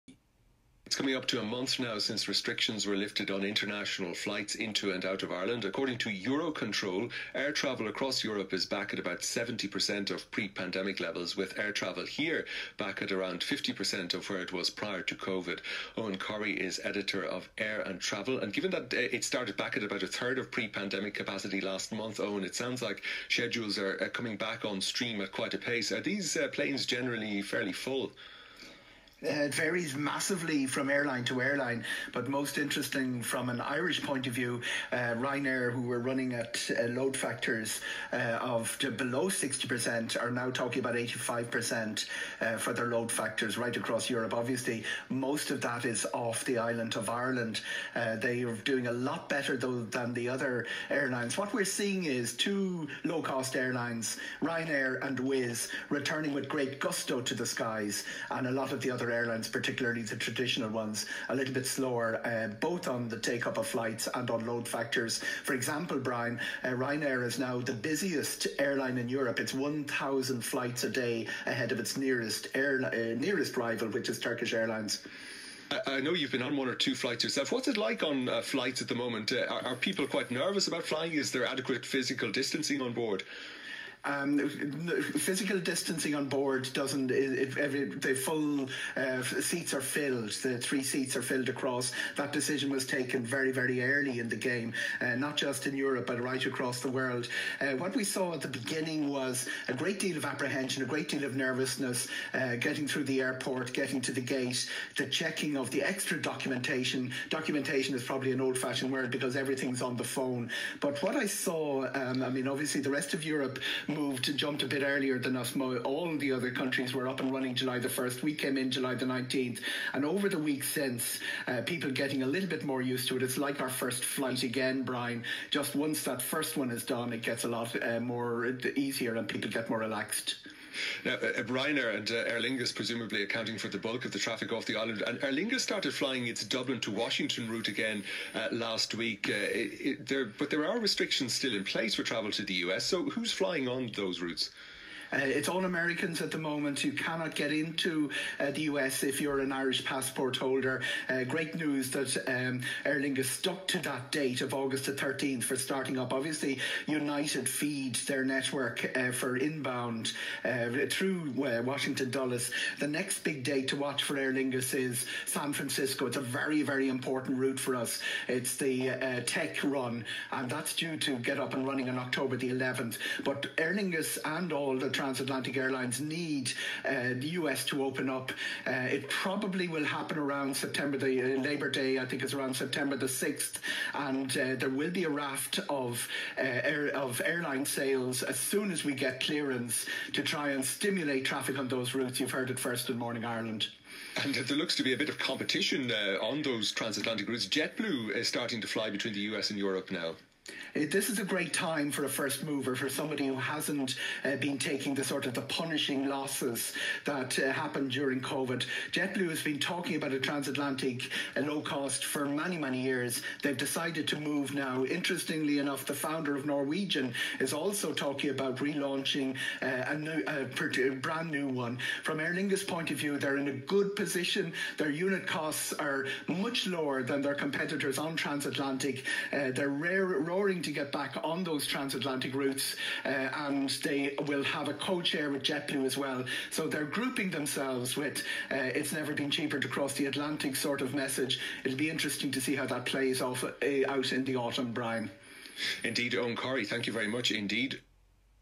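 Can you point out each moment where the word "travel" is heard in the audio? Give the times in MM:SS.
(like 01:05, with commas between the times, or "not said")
00:07, 00:11, 00:18, 02:22.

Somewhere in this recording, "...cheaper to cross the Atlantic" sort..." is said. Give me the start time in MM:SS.
03:59.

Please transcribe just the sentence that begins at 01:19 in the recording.
Uh, are, are, people quite nervous about flying?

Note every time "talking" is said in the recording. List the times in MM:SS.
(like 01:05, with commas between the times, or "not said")
00:40, 03:29, 03:37.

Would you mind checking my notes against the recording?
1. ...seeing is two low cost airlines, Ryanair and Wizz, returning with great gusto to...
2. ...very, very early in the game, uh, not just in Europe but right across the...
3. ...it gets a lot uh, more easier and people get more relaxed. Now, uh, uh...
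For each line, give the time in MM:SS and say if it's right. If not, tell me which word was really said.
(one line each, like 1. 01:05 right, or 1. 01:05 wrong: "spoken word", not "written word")
1. 00:51 right
2. 01:33 right
3. 02:07 right.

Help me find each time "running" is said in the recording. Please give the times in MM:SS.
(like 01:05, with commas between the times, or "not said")
00:35, 01:57, 02:51.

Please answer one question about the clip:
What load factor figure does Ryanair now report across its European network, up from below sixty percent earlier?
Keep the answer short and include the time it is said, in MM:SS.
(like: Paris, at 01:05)
85%, at 00:40.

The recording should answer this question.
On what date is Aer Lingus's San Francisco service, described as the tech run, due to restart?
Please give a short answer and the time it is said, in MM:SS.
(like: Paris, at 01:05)
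October 11, at 02:51.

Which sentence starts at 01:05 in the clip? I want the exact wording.
For example, Brian, uh, Ryanair is now the busiest airline in Europe.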